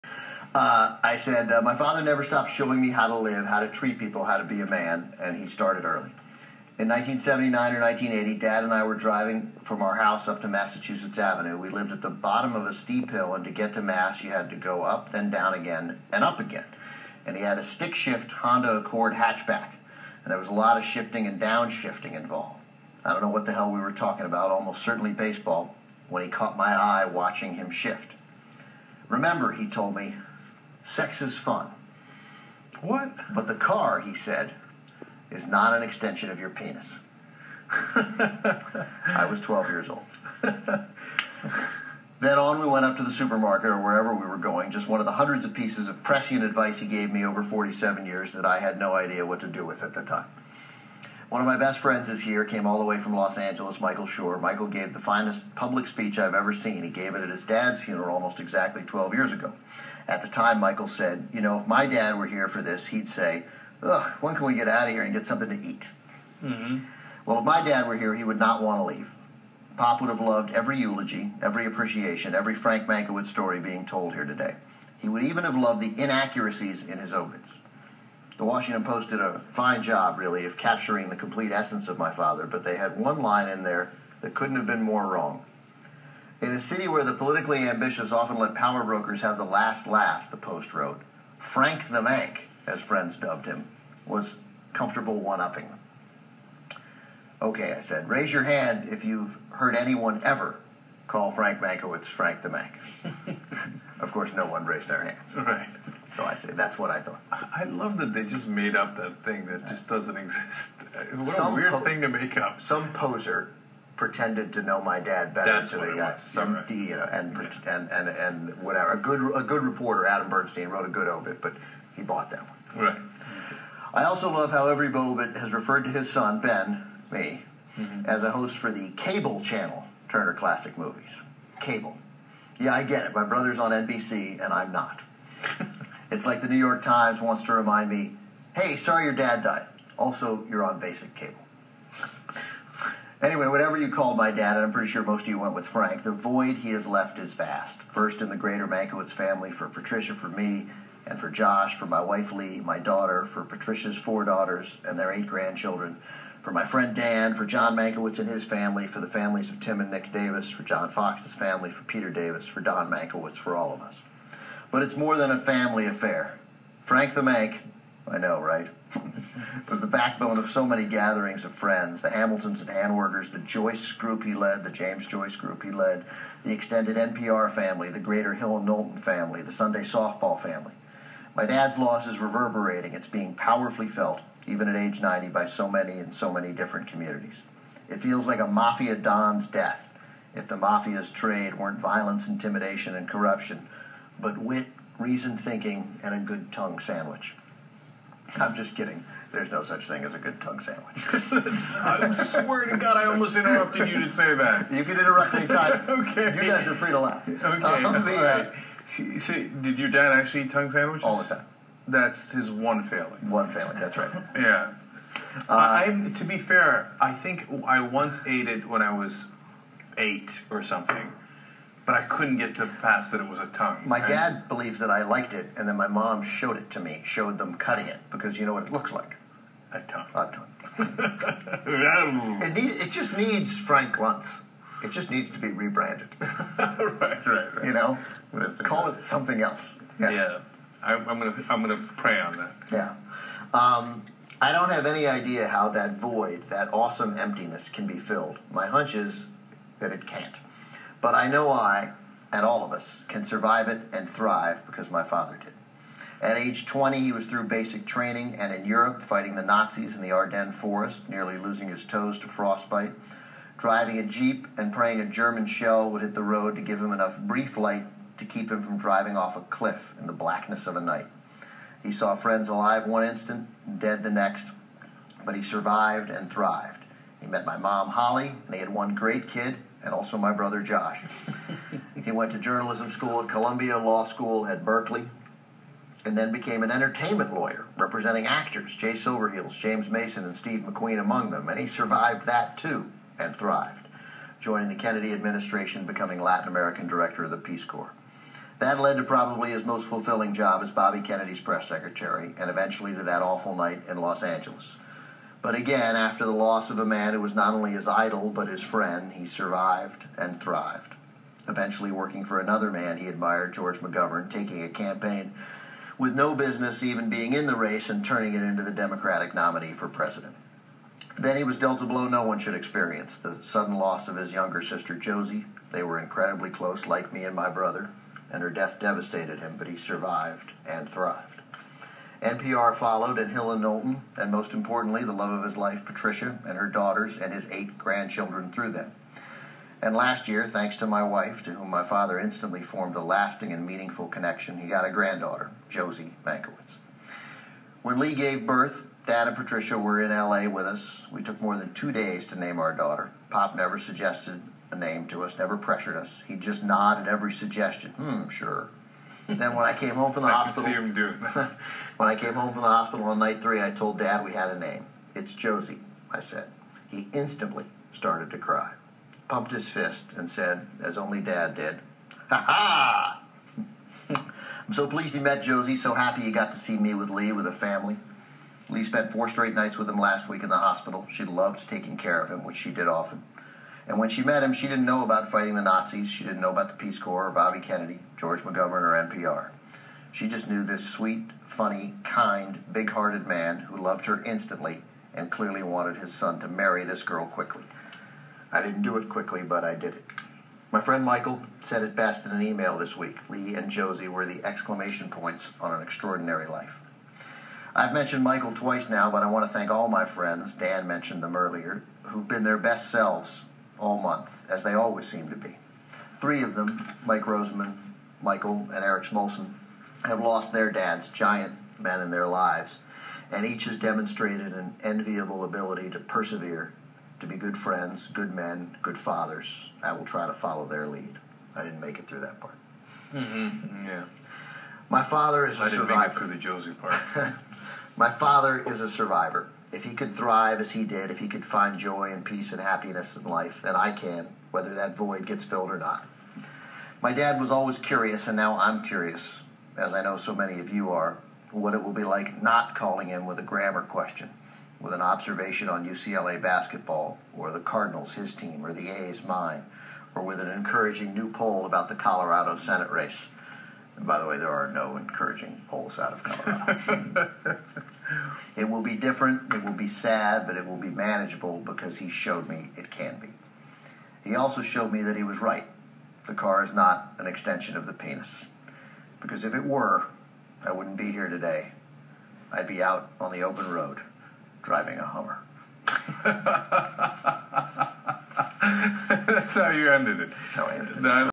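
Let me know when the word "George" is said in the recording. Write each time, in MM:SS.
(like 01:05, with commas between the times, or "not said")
05:13, 06:28.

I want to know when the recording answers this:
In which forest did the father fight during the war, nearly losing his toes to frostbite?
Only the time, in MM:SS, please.
04:20.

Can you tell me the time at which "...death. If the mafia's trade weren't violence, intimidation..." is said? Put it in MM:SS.
03:09.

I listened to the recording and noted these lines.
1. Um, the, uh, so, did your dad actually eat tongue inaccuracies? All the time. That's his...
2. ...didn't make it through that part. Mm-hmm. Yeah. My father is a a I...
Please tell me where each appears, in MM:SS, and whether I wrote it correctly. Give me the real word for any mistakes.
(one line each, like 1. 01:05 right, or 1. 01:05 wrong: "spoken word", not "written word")
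1. 03:27 wrong: "sandwiches", not "inaccuracies"
2. 07:11 right.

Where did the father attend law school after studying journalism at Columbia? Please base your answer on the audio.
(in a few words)
Berkeley.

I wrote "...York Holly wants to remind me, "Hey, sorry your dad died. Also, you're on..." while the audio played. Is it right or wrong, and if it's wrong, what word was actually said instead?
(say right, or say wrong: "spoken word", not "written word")
wrong: "Times", not "Holly".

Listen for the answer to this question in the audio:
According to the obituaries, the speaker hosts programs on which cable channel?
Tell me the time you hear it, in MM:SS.
02:10.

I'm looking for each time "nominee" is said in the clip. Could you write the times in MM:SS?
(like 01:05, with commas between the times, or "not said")
05:19.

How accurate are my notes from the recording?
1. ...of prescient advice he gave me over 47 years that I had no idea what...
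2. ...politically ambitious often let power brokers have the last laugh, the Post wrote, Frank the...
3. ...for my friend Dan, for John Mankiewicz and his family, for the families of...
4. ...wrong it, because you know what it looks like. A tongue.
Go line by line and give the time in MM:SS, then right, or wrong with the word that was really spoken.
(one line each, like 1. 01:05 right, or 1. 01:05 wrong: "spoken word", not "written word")
1. 00:45 right
2. 01:27 right
3. 02:36 right
4. 03:47 wrong: "cutting", not "wrong".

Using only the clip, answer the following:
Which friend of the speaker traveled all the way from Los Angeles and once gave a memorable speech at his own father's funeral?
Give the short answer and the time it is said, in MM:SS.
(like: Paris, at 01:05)
Michael Shore, at 00:53.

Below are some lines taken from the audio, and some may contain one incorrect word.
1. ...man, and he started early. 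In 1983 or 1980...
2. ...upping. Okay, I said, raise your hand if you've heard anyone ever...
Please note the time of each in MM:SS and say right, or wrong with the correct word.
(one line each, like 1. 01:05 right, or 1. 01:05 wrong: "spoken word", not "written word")
1. 00:04 wrong: "1979", not "1983"
2. 01:35 right.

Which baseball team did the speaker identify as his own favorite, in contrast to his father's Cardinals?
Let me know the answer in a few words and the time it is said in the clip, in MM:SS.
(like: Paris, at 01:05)
the A's, at 07:38.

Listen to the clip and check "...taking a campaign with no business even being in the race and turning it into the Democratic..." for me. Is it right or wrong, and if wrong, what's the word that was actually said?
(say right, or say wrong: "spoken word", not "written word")
right.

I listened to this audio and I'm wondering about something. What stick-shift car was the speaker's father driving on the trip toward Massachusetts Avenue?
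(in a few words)
Honda Accord.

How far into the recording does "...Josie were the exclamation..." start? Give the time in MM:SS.
06:43.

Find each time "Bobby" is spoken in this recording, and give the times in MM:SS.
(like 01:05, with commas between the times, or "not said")
05:00, 06:27.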